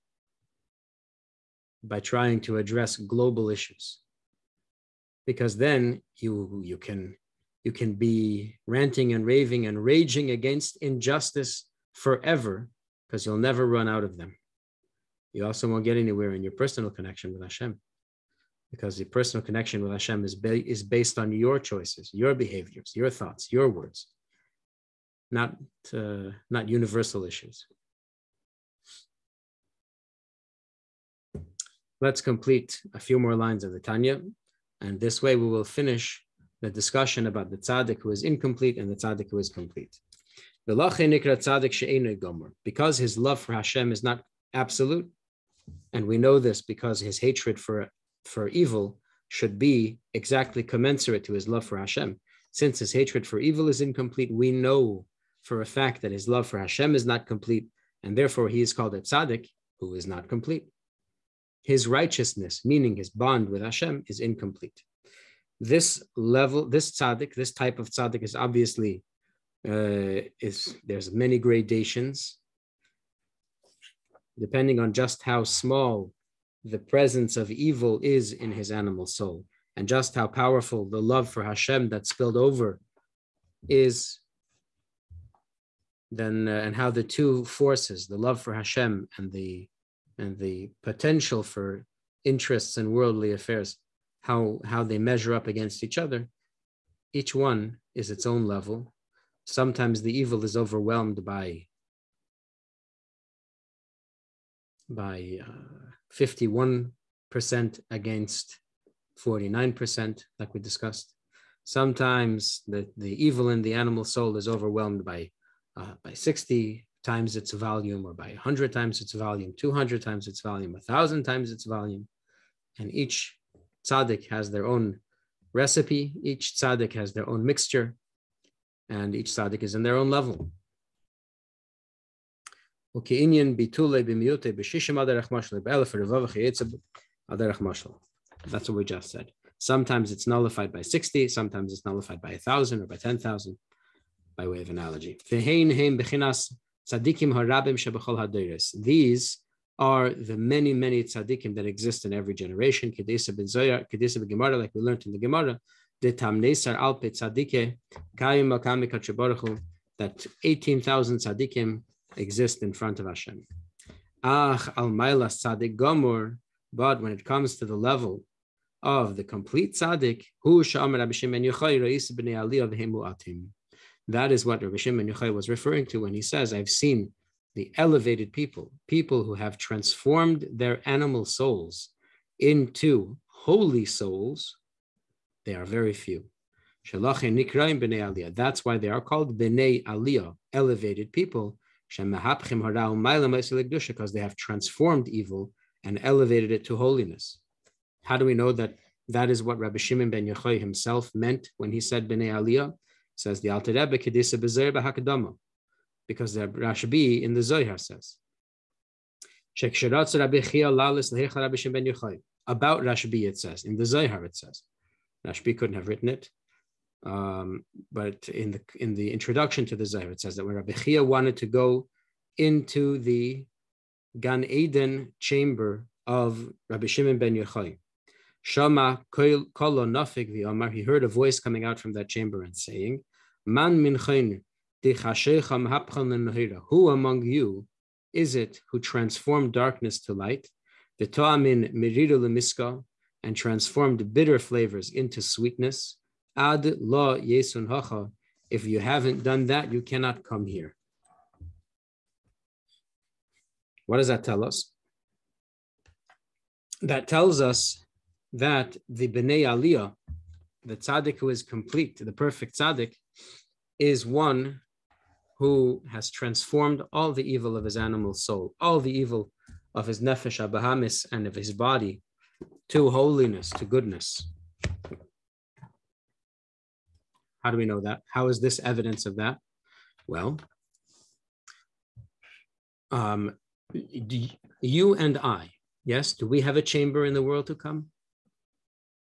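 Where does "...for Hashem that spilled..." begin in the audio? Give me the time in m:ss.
1:21.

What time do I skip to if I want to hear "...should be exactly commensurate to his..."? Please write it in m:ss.
0:49.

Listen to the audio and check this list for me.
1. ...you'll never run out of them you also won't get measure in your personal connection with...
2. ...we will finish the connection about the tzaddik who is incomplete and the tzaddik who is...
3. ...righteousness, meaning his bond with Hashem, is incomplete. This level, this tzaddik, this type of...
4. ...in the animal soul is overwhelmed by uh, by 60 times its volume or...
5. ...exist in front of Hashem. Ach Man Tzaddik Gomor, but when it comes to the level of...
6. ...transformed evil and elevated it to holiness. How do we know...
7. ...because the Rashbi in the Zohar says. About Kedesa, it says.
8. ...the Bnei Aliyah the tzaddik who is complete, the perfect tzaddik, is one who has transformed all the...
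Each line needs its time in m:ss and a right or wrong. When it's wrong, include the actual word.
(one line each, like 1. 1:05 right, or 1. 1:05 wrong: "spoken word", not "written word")
1. 0:13 wrong: "anywhere", not "measure"
2. 0:35 wrong: "discussion", not "connection"
3. 1:01 right
4. 1:53 right
5. 2:42 wrong: "Almaila", not "Man"
6. 3:14 right
7. 3:26 wrong: "Rashbi", not "Kedesa"
8. 4:18 right.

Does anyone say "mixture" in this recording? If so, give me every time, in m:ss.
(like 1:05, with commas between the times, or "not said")
2:07.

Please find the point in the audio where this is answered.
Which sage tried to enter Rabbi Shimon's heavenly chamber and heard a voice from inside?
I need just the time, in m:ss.
3:40.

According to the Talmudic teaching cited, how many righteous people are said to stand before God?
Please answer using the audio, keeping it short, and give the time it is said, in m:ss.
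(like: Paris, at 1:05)
18,000, at 2:36.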